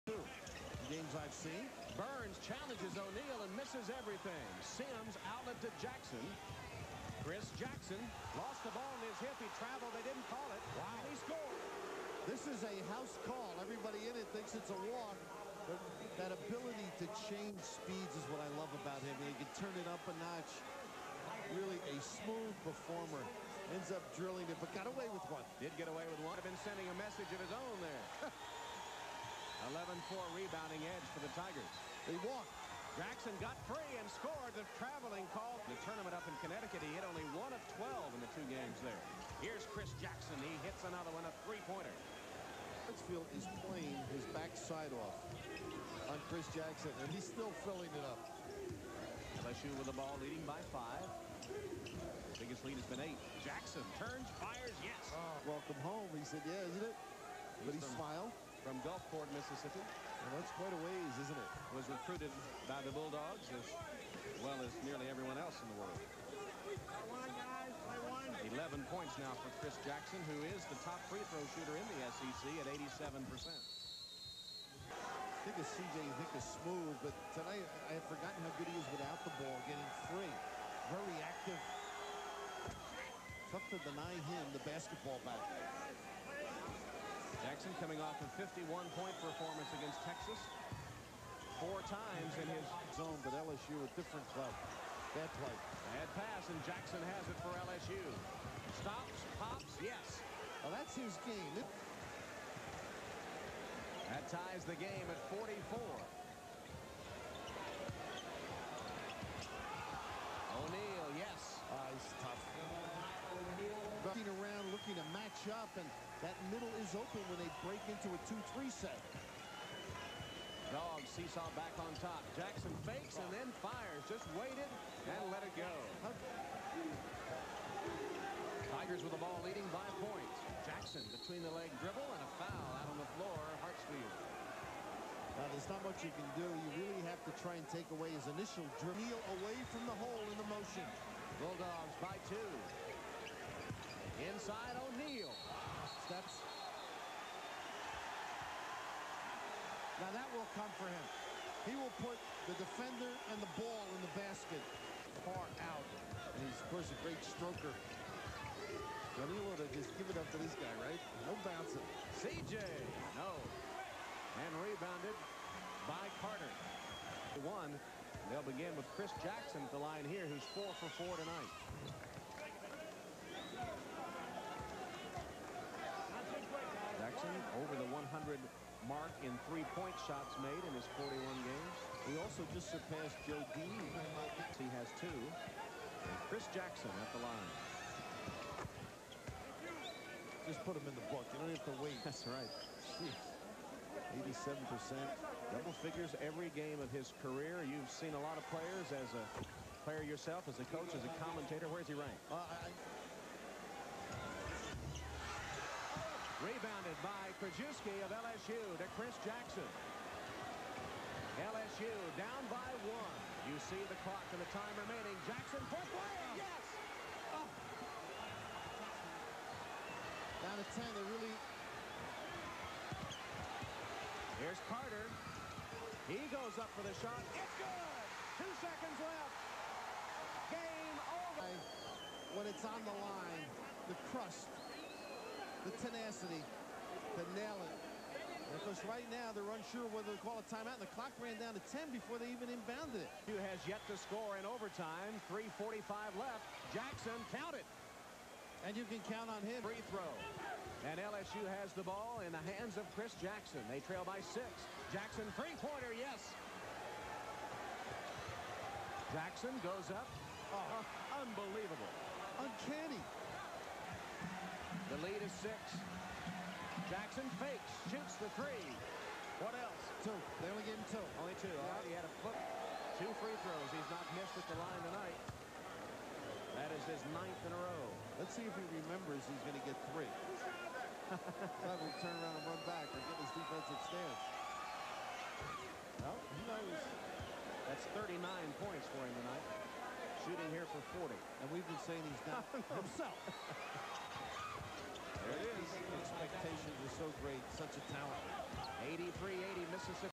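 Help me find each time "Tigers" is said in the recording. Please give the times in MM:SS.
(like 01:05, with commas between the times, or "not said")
00:31, 02:08.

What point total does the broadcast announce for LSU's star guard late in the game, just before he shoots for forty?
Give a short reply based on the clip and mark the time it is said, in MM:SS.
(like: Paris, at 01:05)
39, at 04:47.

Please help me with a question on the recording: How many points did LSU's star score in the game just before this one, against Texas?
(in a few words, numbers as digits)
51.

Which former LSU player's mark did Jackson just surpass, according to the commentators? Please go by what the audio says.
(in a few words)
Joe Dean.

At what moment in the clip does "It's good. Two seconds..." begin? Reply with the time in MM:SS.
03:47.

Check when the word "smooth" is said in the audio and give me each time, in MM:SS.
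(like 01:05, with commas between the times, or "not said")
00:21, 01:16.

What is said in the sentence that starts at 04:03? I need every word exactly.
Who has yet to score in overtime.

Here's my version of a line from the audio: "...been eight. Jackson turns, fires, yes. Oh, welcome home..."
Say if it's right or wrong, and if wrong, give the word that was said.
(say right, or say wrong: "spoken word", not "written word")
right.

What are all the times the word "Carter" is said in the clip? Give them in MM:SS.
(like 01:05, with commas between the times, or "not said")
02:46, 03:44.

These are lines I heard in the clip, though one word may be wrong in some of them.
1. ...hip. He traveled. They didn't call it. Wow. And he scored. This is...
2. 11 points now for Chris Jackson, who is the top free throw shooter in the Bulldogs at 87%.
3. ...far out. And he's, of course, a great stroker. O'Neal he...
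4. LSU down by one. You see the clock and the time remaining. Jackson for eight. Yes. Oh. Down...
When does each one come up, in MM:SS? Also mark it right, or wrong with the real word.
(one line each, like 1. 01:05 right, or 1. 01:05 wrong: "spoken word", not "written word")
1. 00:09 right
2. 01:08 wrong: "SEC", not "Bulldogs"
3. 02:35 right
4. 03:31 wrong: "three", not "eight".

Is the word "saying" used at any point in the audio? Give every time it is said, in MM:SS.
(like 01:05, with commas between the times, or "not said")
04:51.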